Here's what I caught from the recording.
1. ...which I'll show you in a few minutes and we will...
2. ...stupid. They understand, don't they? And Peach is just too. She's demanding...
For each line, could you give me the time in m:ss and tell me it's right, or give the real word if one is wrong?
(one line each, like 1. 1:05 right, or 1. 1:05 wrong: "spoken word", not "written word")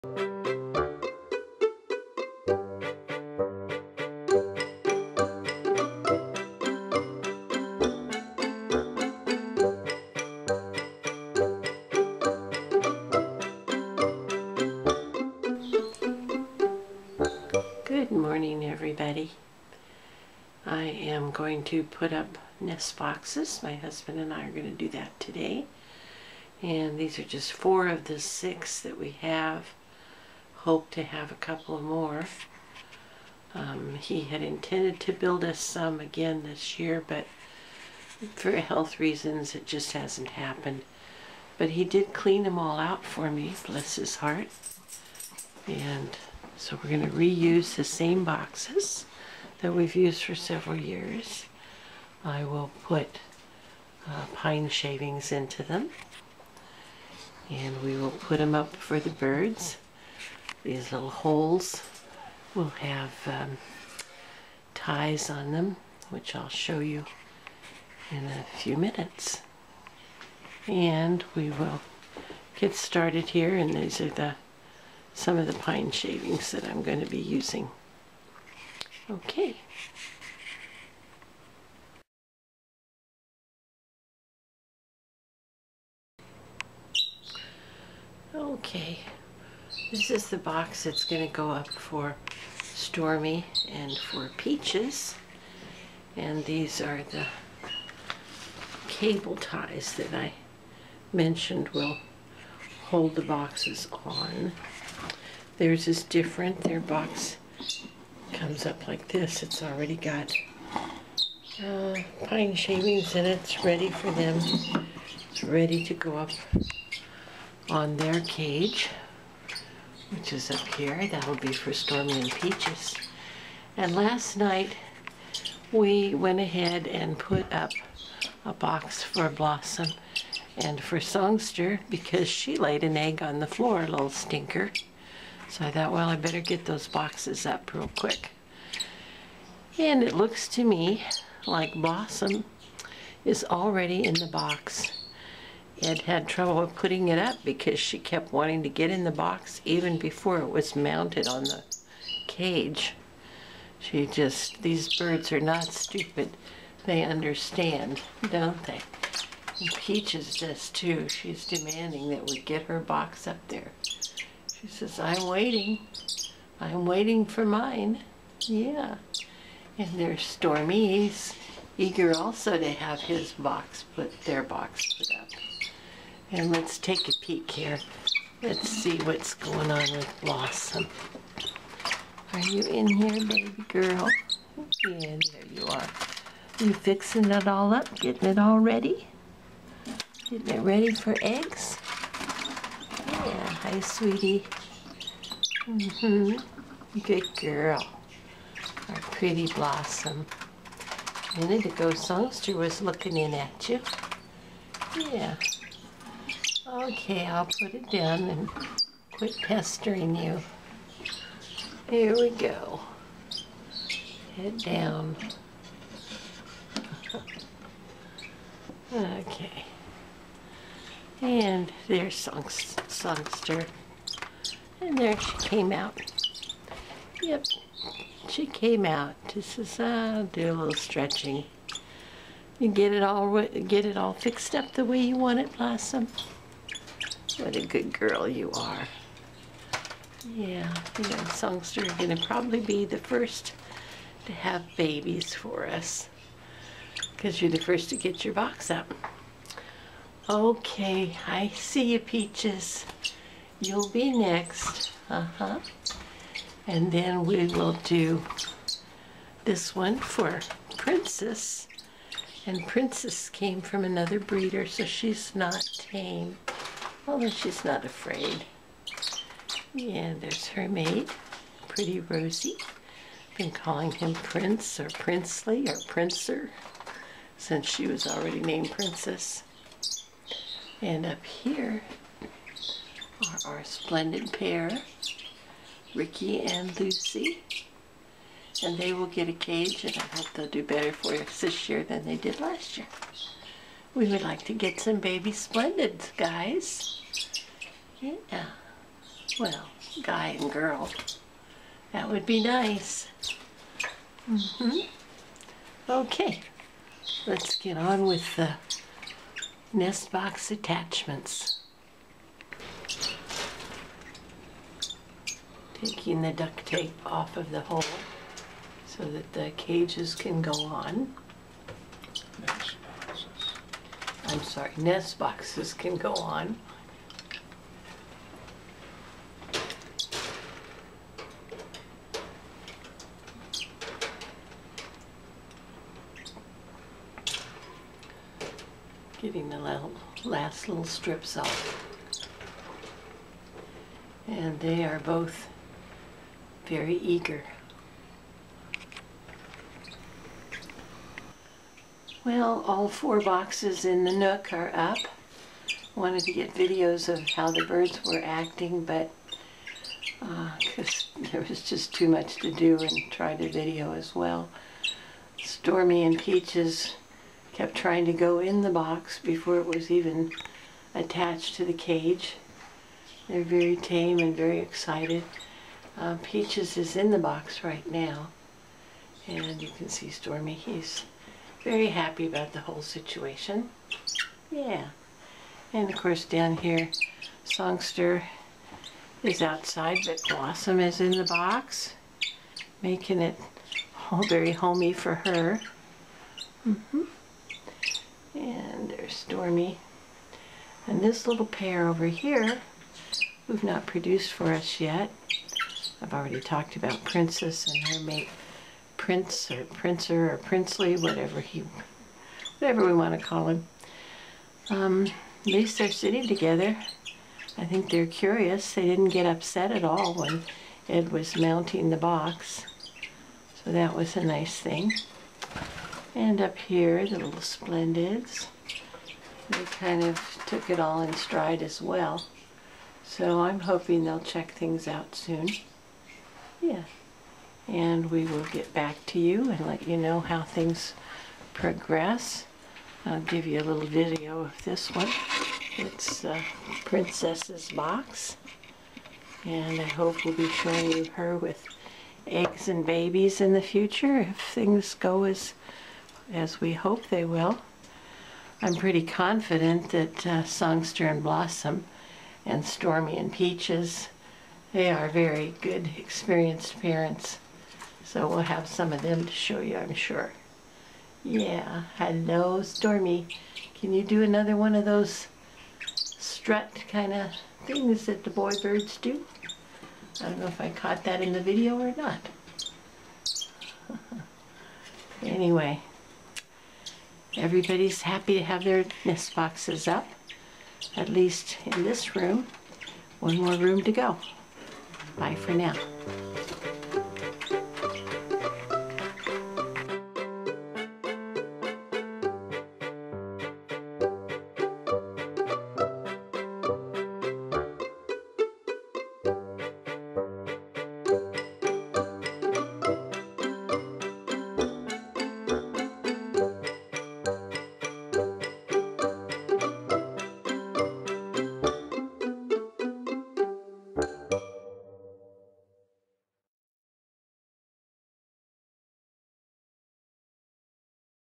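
1. 1:06 right
2. 2:35 right.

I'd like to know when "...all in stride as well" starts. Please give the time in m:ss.
7:10.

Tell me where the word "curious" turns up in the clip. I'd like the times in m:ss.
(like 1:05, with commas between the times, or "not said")
6:58.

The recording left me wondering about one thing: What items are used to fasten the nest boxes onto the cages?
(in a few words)
Cable ties.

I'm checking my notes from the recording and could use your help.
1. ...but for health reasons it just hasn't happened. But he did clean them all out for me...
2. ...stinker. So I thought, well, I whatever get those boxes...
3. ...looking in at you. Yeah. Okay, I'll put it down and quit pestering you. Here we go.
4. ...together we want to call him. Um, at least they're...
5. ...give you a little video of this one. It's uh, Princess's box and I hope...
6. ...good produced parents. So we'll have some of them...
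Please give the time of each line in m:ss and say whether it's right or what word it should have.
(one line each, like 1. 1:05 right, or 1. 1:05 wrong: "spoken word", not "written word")
1. 0:37 right
2. 2:14 wrong: "better", not "whatever"
3. 3:22 right
4. 6:52 wrong: "whatever", not "together"
5. 7:23 right
6. 7:45 wrong: "experienced", not "produced".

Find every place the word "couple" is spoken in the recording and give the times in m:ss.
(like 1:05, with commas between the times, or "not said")
0:31.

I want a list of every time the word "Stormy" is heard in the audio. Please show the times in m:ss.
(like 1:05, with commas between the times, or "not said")
1:32, 2:01, 2:50, 6:05, 6:20, 6:39, 7:42, 7:52.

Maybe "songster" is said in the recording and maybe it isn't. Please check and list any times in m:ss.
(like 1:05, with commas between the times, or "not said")
2:10, 3:21, 3:42, 4:01, 6:27, 7:40.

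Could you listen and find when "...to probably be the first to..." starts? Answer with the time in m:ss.
4:02.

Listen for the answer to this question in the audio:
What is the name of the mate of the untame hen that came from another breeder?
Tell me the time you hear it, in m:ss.
4:31.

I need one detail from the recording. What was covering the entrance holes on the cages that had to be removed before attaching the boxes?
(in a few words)
Duct tape.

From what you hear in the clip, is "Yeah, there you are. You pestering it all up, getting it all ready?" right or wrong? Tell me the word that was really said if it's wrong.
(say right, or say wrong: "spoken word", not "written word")
wrong: "fixing", not "pestering".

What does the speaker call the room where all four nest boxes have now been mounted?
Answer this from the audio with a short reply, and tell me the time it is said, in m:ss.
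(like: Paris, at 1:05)
The Nook, at 5:54.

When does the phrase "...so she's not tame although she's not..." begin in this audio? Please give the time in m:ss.
4:24.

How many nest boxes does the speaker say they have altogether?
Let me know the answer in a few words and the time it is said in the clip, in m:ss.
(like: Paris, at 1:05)
6, at 0:28.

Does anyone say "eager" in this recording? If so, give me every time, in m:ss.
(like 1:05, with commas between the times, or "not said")
2:51, 5:46.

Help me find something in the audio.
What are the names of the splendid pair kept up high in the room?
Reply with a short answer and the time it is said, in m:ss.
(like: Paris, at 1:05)
Ricky and Lucy, at 4:45.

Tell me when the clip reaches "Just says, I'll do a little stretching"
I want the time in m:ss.
3:49.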